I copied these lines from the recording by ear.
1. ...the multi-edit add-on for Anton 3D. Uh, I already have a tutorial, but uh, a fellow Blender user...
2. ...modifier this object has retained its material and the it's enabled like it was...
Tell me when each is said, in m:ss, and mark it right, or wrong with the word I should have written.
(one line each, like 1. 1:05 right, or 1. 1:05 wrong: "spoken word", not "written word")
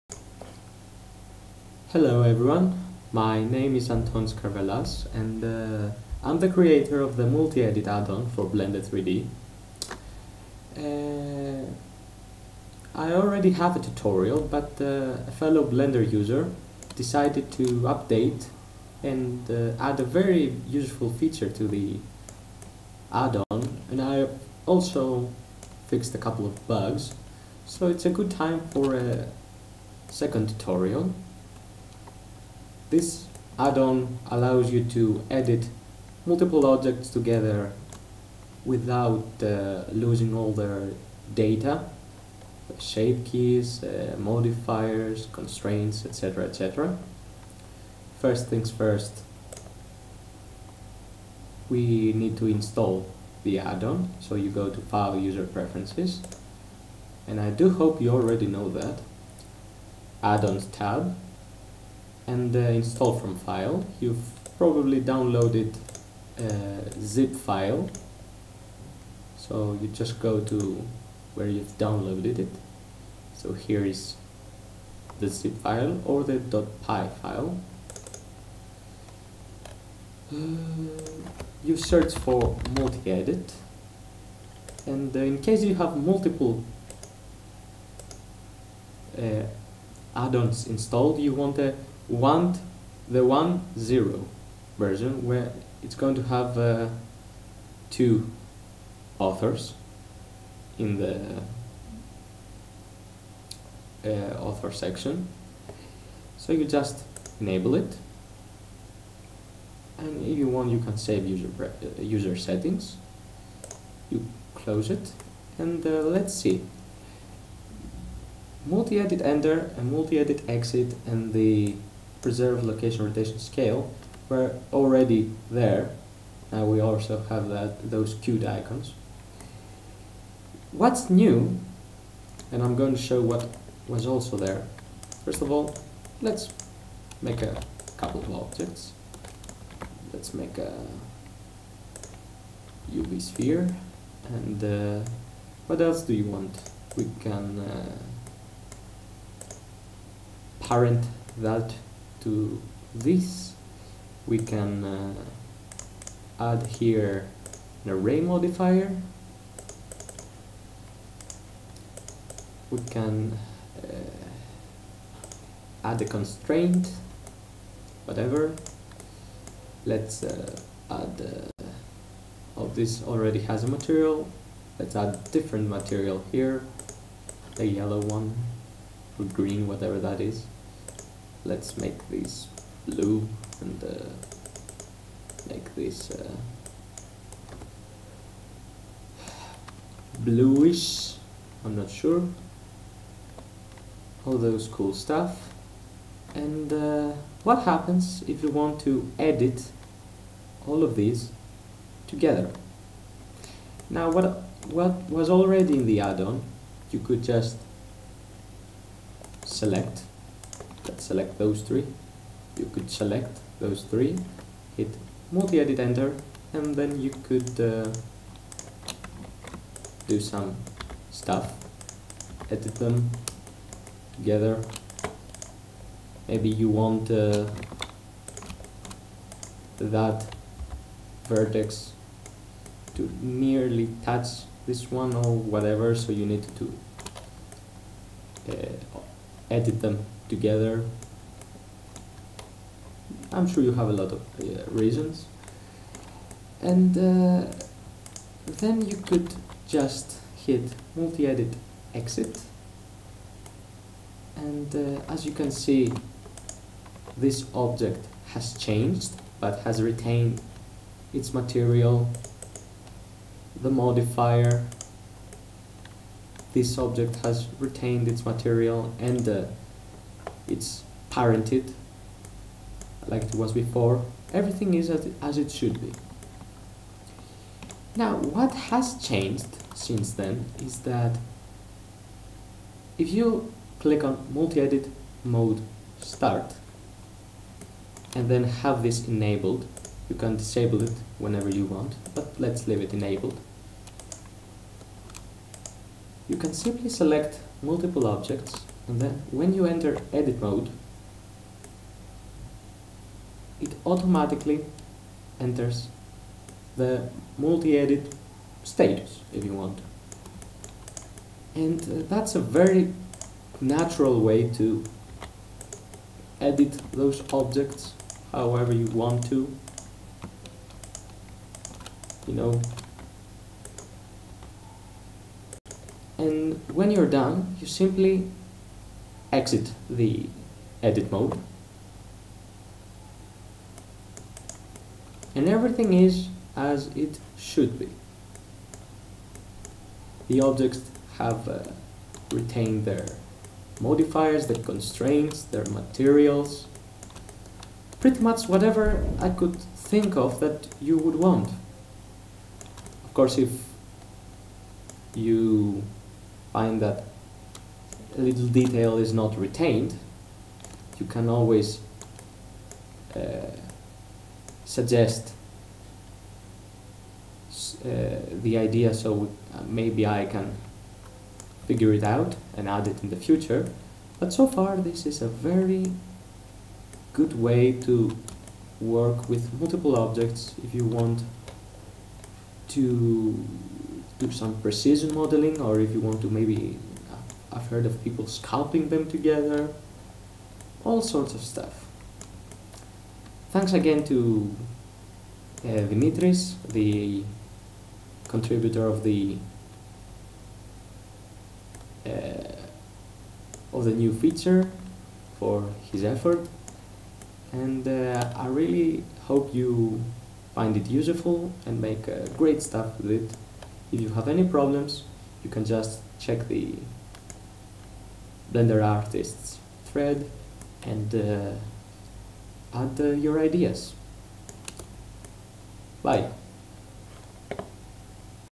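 1. 0:07 wrong: "Blender", not "Anton"
2. 4:23 wrong: "parented", not "enabled".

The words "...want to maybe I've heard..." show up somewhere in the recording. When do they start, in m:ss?
6:25.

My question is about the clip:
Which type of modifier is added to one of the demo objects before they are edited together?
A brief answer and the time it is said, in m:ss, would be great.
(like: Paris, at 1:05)
array modifier, at 2:37.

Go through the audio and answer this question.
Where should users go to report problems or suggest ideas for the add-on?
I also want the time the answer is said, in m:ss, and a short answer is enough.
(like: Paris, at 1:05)
Blender Artists thread, at 6:58.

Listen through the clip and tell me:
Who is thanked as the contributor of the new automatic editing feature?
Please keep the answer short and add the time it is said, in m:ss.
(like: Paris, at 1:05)
Dimitris, at 6:35.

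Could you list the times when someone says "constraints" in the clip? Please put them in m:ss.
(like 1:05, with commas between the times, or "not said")
0:45, 2:46, 5:44.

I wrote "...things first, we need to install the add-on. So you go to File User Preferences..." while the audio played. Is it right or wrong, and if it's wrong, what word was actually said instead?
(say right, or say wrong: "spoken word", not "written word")
right.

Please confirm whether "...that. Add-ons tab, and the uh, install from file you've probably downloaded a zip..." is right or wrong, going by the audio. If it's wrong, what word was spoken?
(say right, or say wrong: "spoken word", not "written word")
right.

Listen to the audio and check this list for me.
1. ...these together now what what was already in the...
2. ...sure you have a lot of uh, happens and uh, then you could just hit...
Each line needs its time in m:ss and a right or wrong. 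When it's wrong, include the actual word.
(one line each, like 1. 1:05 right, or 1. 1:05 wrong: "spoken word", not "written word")
1. 3:20 right
2. 4:03 wrong: "reasons", not "happens".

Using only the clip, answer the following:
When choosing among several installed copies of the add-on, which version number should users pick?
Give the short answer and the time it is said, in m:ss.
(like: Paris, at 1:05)
1.0, at 1:33.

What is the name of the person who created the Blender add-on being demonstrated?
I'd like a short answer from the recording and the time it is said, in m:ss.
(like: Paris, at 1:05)
Anton Skarvelas, at 0:03.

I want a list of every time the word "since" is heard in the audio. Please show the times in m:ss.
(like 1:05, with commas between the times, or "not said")
4:39.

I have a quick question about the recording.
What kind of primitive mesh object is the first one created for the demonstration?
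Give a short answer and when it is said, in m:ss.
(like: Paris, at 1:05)
UV sphere, at 2:22.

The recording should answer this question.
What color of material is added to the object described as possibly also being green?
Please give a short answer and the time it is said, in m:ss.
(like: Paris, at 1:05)
yellow, at 2:57.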